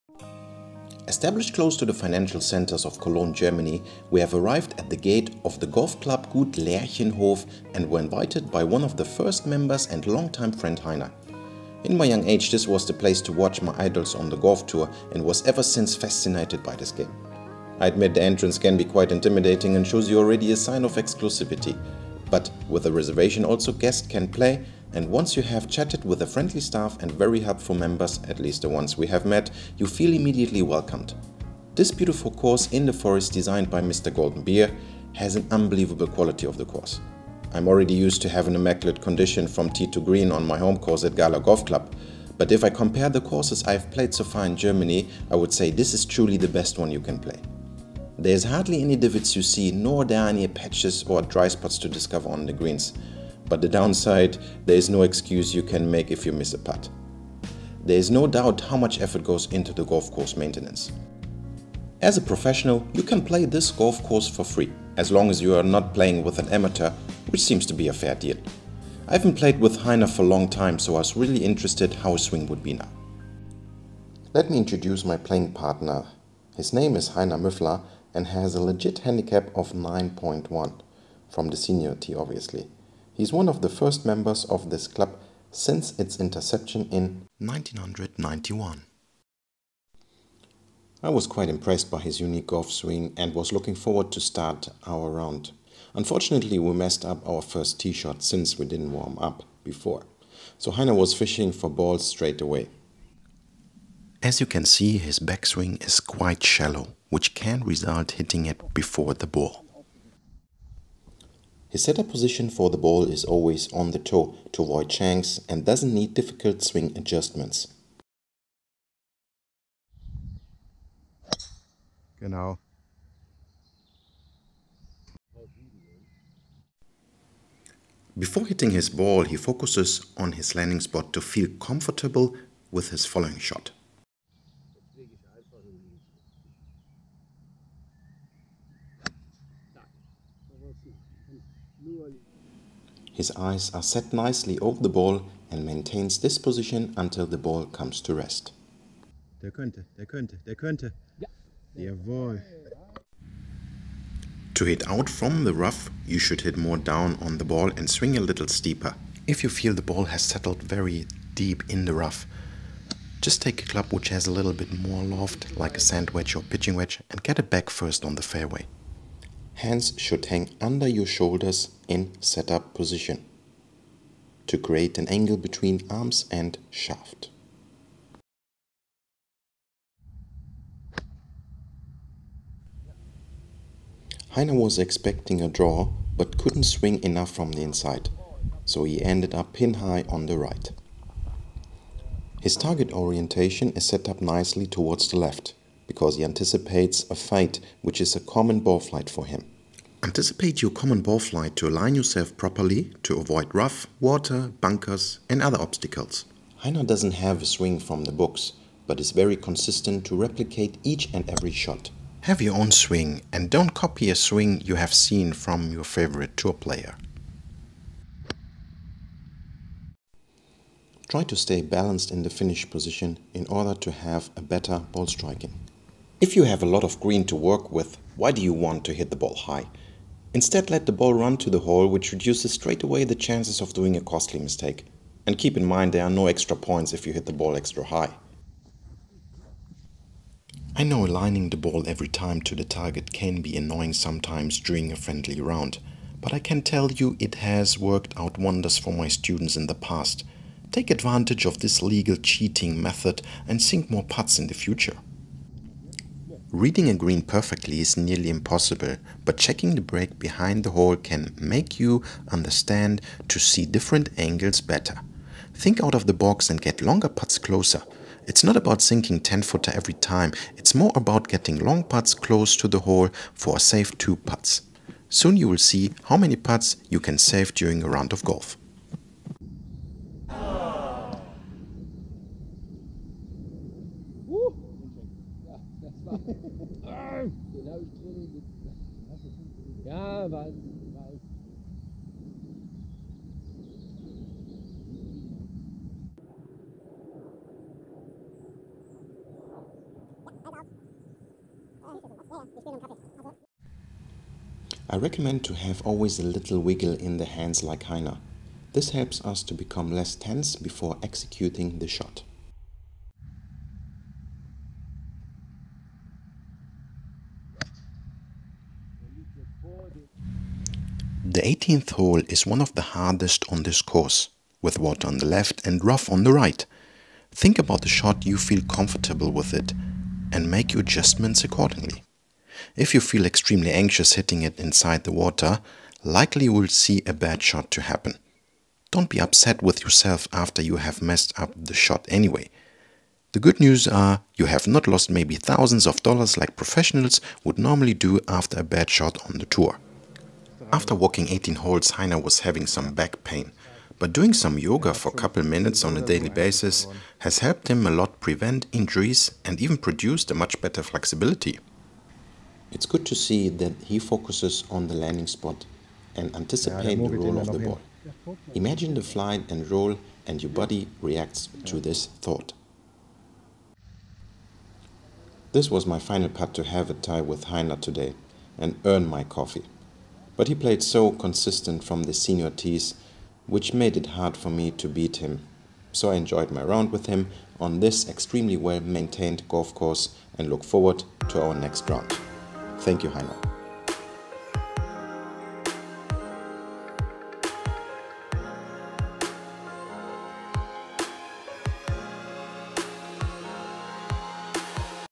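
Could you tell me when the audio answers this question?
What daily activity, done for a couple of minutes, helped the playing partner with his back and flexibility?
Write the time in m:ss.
5:54.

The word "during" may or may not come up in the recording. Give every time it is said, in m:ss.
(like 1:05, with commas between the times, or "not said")
4:04, 4:37.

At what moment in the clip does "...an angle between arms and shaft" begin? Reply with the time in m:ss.
2:54.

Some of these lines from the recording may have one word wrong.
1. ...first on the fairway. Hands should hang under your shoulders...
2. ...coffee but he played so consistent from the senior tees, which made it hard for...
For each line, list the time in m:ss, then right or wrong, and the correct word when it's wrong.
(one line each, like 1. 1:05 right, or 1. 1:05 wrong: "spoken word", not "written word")
1. 2:47 right
2. 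6:19 right.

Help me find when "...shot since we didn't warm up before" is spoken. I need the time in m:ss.
1:37.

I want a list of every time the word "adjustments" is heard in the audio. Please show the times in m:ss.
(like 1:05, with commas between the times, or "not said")
1:56, 5:30.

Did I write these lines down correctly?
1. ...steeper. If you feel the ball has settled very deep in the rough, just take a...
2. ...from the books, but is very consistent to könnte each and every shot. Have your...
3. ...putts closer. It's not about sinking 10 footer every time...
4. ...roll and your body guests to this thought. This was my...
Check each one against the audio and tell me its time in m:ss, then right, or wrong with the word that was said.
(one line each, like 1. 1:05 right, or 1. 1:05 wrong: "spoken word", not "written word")
1. 2:38 right
2. 3:27 wrong: "replicate", not "könnte"
3. 4:27 right
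4. 6:09 wrong: "reacts", not "guests".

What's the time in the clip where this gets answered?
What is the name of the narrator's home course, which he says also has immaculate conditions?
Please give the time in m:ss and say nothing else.
0:41.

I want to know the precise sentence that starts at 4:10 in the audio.
Take advantage of this legal cheating method and sink more putts in the future.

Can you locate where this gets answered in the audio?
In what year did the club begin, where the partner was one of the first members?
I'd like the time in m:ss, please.
1:27.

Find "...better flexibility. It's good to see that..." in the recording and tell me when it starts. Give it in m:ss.
6:00.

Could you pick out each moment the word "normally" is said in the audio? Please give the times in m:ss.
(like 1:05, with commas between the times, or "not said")
5:47.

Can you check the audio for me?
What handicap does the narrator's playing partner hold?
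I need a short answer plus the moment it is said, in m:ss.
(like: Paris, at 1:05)
9.1, at 1:19.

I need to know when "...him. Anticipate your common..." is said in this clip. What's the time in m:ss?
3:19.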